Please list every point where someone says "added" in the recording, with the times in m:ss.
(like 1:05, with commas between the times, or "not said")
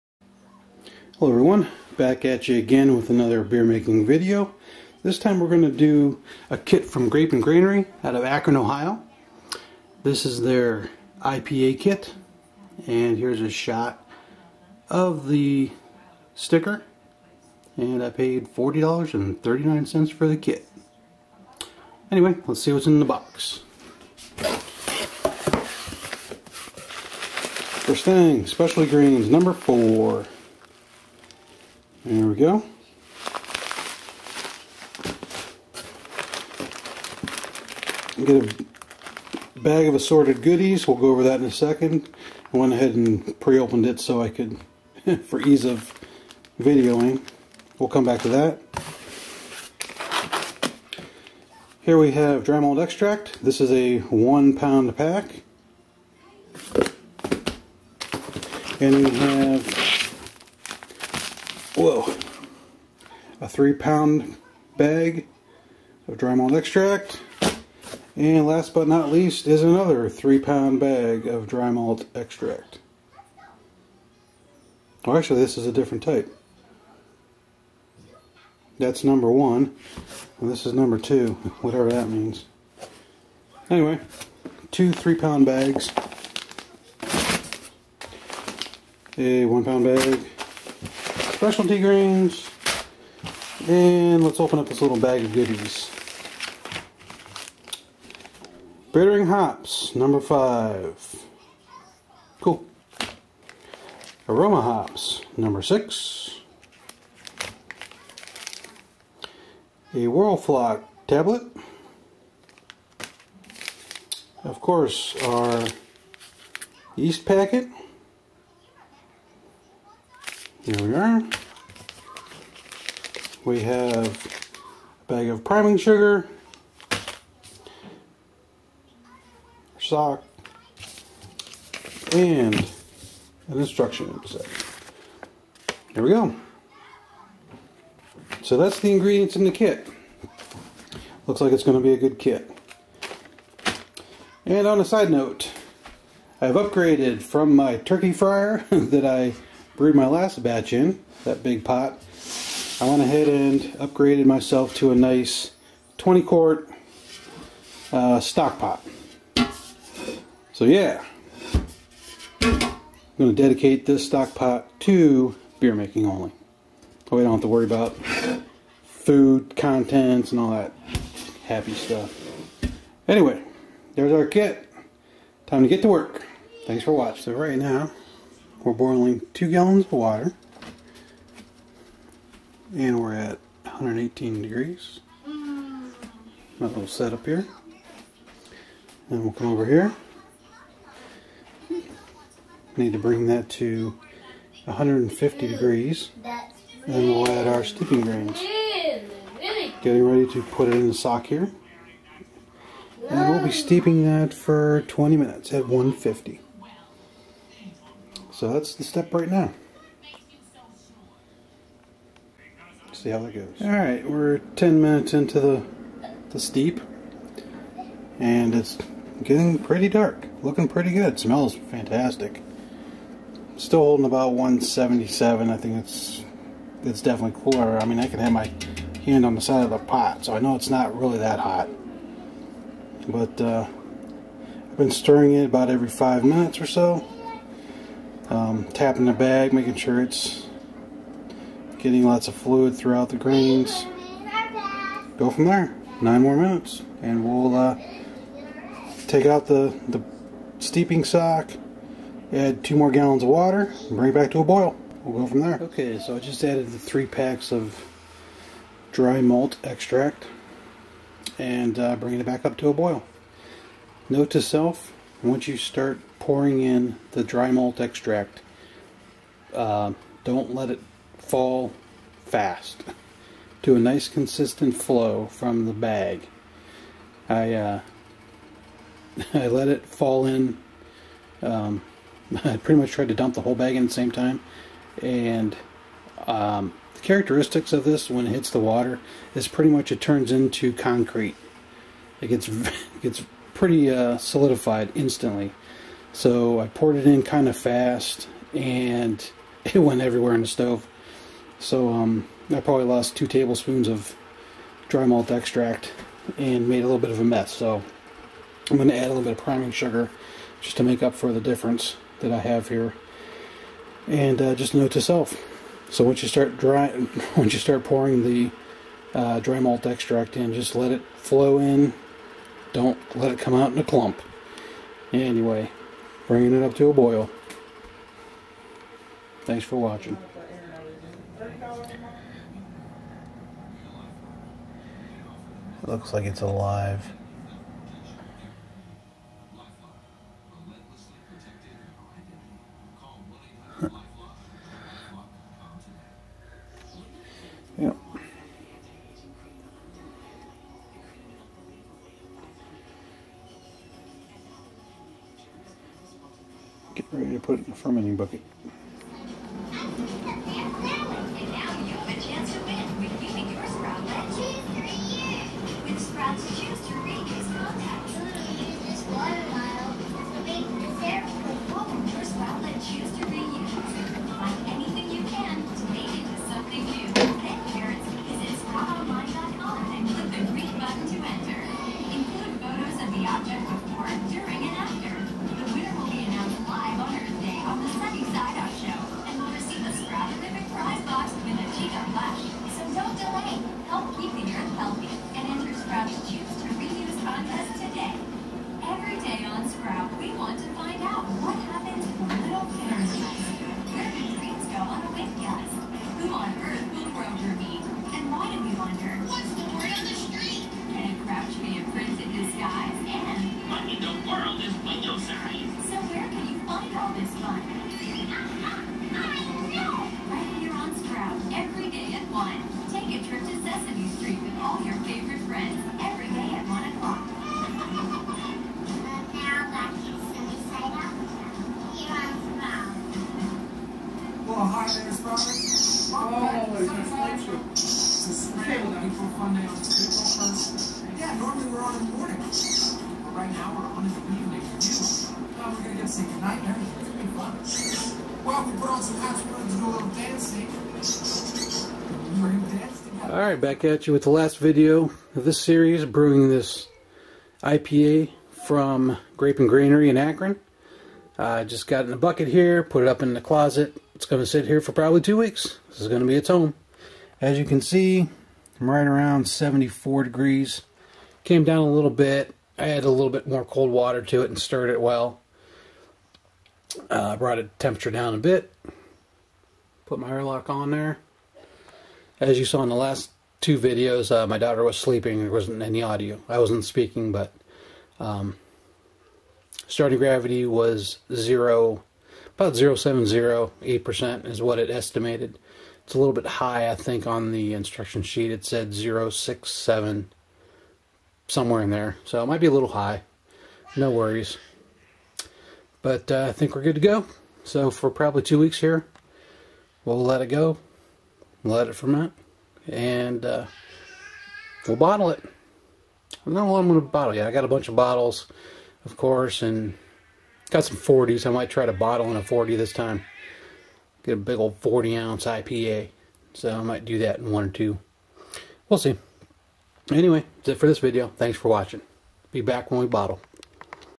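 4:16, 7:52.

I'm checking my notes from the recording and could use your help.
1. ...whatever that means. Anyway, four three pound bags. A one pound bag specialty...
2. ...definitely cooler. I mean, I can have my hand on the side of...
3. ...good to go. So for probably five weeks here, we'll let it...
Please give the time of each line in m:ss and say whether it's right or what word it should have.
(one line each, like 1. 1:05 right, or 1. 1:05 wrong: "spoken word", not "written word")
1. 1:21 wrong: "two", not "four"
2. 3:47 right
3. 8:26 wrong: "two", not "five".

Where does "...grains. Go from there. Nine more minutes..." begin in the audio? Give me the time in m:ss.
4:03.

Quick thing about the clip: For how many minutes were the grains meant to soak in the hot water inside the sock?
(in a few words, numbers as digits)
20.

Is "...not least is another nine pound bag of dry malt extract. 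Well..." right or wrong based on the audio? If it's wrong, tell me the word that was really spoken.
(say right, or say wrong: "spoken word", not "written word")
wrong: "three", not "nine".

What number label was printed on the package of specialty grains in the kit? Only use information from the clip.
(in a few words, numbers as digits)
4.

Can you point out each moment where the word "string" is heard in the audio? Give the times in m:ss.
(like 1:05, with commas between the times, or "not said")
not said.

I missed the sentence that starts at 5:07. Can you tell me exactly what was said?
So I'm going to add a little bit of priming sugar just to make up for the difference that I have here.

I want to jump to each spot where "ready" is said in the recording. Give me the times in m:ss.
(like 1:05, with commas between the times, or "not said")
3:20, 5:57.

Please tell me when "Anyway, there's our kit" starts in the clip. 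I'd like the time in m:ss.
2:53.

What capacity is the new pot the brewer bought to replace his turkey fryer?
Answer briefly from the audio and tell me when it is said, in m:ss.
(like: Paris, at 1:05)
20 quart, at 2:35.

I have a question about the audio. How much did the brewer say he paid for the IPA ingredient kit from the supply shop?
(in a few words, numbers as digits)
$40.39.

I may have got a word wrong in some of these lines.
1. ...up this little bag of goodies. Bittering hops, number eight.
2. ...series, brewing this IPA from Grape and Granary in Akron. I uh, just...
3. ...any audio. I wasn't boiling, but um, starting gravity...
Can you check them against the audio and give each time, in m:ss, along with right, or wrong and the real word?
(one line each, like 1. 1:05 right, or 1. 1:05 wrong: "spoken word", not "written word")
1. 1:34 wrong: "five", not "eight"
2. 7:35 right
3. 8:05 wrong: "speaking", not "boiling".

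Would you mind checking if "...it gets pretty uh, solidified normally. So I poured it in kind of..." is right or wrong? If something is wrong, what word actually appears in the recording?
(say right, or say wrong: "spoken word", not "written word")
wrong: "instantly", not "normally".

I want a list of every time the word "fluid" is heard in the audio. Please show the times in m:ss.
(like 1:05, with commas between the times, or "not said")
4:02.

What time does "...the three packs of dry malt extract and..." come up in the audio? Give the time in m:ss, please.
4:16.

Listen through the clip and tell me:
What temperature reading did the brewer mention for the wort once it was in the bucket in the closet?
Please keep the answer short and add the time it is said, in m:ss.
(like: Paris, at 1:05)
74 degrees, at 7:49.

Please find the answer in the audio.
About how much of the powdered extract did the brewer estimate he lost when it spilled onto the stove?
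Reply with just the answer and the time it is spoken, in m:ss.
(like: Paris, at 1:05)
2 tablespoons, at 5:03.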